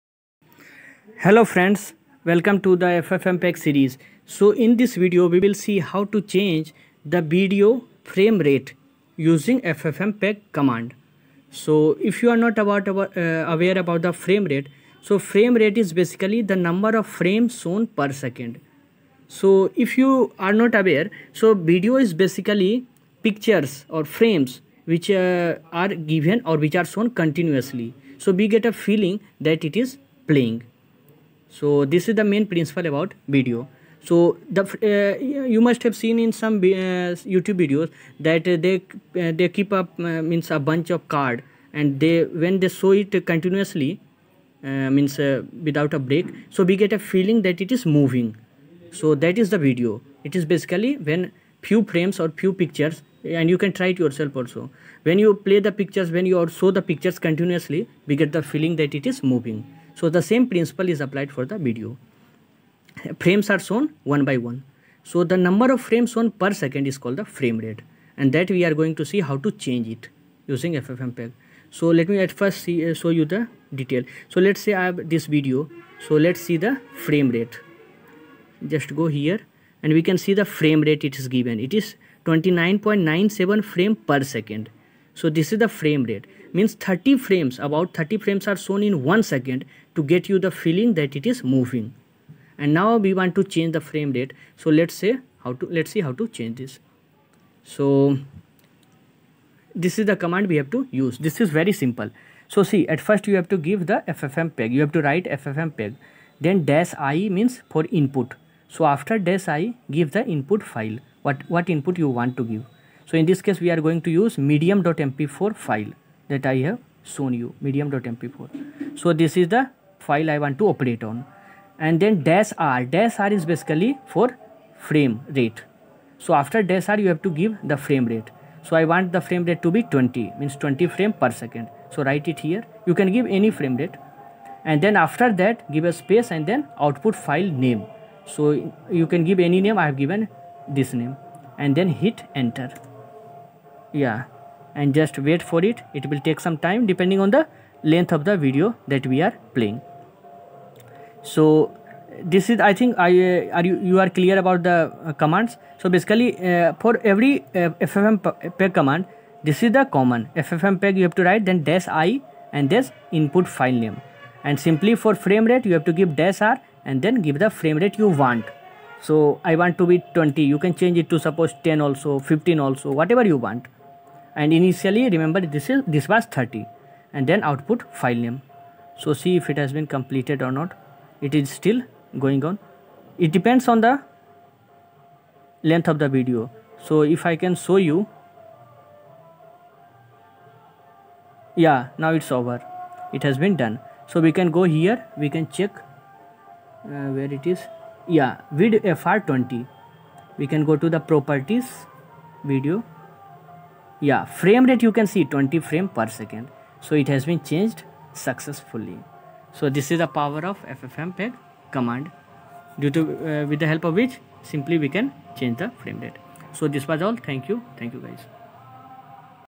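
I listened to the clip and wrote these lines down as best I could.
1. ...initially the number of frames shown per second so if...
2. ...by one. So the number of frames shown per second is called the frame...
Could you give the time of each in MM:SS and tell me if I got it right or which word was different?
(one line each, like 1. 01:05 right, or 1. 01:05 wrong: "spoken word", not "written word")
1. 00:15 wrong: "basically", not "initially"
2. 01:04 right.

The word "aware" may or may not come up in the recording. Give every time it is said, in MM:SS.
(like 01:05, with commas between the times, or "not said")
00:13, 00:20.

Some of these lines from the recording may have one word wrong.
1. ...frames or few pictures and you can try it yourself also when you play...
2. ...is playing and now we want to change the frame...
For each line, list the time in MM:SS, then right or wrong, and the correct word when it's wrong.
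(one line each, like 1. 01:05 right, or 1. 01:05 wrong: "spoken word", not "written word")
1. 00:51 right
2. 01:31 wrong: "moving", not "playing".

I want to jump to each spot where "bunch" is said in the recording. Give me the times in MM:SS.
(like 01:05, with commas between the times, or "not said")
00:40.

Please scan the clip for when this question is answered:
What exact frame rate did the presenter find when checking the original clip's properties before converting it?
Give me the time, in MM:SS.
01:22.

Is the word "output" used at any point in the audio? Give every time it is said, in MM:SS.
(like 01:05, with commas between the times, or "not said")
02:16, 02:57.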